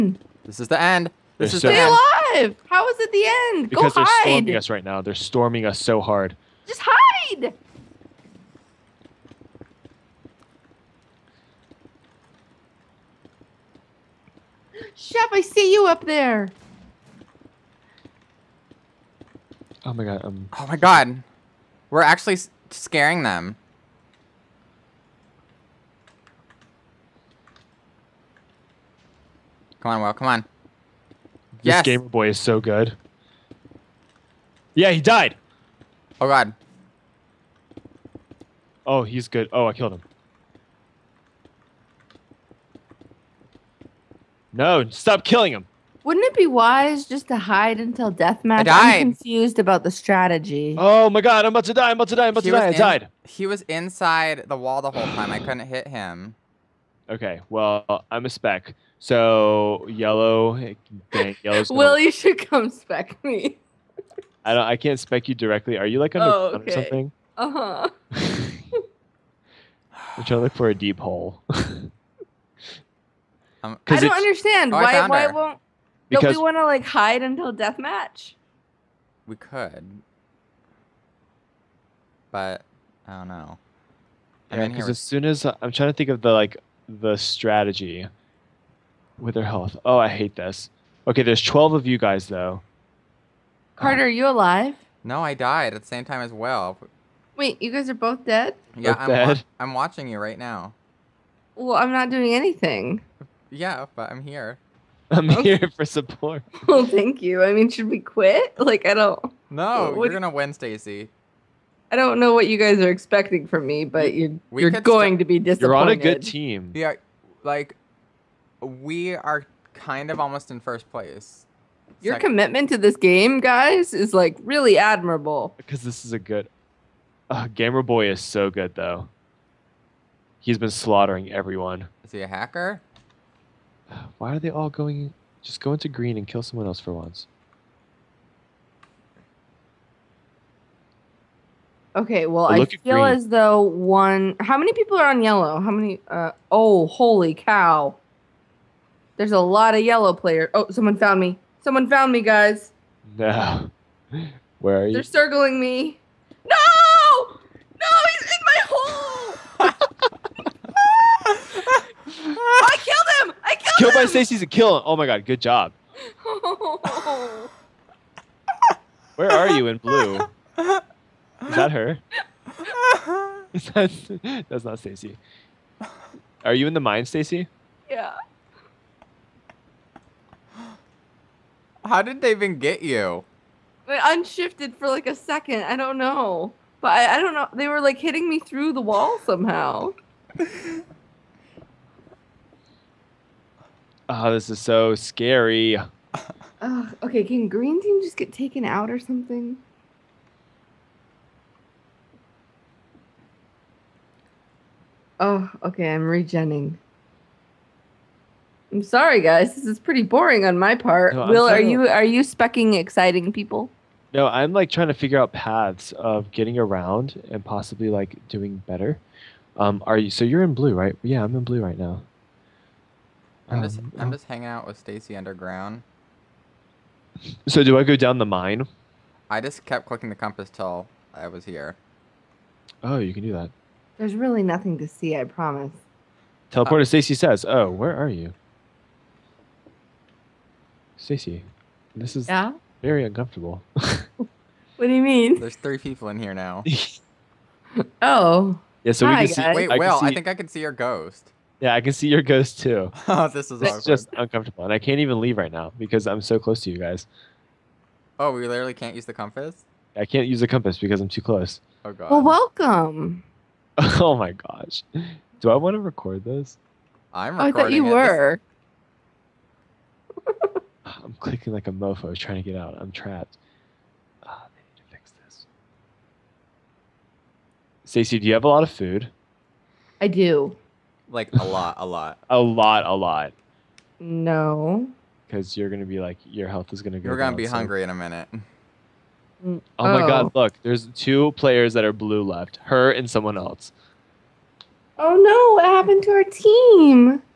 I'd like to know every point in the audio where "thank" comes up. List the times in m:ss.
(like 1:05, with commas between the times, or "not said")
1:46.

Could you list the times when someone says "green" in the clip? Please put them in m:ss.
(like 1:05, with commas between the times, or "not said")
2:15, 3:17.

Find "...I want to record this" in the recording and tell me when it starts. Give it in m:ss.
4:25.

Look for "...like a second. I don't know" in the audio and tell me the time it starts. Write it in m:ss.
3:04.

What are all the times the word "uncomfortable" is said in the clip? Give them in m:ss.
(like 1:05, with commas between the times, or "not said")
4:03, 4:14.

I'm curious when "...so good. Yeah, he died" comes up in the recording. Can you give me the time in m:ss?
0:32.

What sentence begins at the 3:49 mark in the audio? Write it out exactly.
I just kept clicking the compass till I was here.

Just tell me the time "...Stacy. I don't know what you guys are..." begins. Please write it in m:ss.
1:50.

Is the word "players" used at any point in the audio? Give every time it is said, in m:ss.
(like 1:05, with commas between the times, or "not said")
2:30, 4:51.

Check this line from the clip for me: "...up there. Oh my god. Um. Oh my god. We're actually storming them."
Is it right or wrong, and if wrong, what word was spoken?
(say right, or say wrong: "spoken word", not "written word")
wrong: "scaring", not "storming".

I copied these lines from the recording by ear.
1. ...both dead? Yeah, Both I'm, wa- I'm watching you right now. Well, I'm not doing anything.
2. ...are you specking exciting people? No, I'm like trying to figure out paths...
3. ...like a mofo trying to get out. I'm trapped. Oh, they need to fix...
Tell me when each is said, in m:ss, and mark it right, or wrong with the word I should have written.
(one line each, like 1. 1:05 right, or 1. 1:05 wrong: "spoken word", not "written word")
1. 1:37 right
2. 3:31 right
3. 4:31 right.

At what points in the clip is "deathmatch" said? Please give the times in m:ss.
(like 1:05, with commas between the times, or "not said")
0:48, 1:17.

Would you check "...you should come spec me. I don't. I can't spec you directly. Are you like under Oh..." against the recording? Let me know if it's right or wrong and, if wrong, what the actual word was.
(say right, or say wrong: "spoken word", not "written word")
right.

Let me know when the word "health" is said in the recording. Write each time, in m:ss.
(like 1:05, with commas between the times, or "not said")
1:29, 4:46.